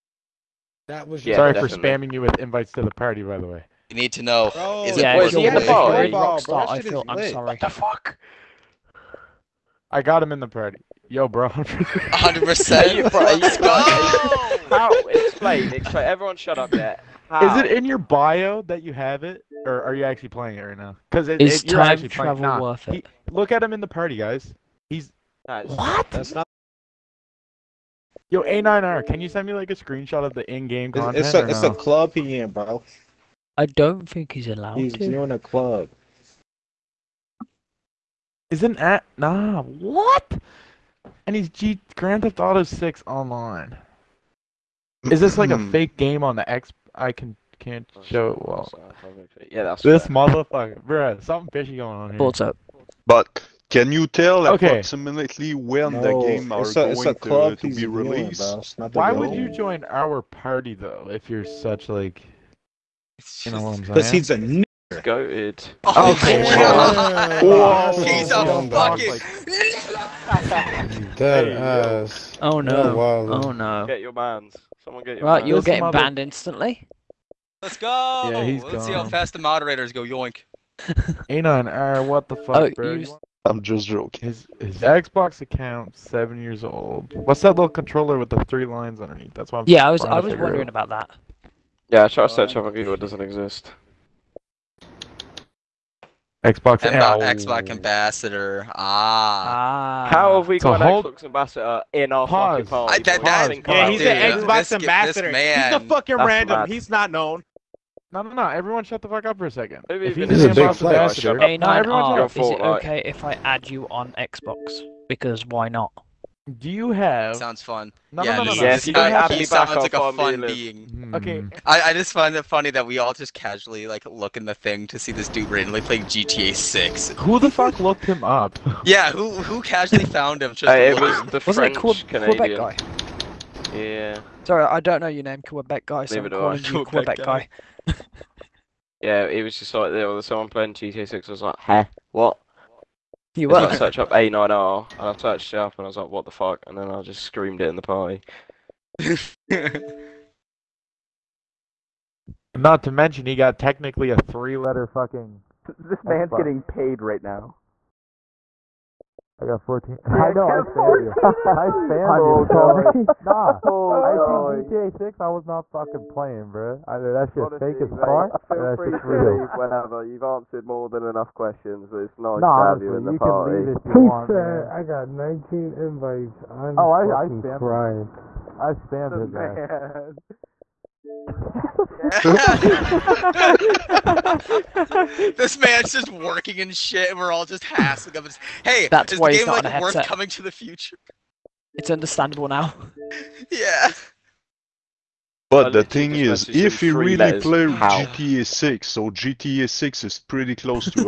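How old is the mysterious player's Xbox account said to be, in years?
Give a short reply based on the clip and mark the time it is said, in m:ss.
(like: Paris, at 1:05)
7, at 1:25.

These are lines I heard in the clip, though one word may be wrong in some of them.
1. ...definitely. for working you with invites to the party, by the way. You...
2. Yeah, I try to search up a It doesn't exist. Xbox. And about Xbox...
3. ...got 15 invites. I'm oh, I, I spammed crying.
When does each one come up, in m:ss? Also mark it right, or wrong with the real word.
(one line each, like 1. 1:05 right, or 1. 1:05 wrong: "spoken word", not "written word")
1. 0:01 wrong: "spamming", not "working"
2. 1:31 right
3. 2:54 wrong: "19", not "15".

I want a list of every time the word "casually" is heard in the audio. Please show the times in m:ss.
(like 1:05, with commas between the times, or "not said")
2:03, 2:09.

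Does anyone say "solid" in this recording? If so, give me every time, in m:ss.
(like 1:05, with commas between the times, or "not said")
not said.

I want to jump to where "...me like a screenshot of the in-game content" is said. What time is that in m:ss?
0:29.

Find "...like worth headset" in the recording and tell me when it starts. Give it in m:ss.
3:09.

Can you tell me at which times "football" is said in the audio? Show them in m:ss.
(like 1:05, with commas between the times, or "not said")
not said.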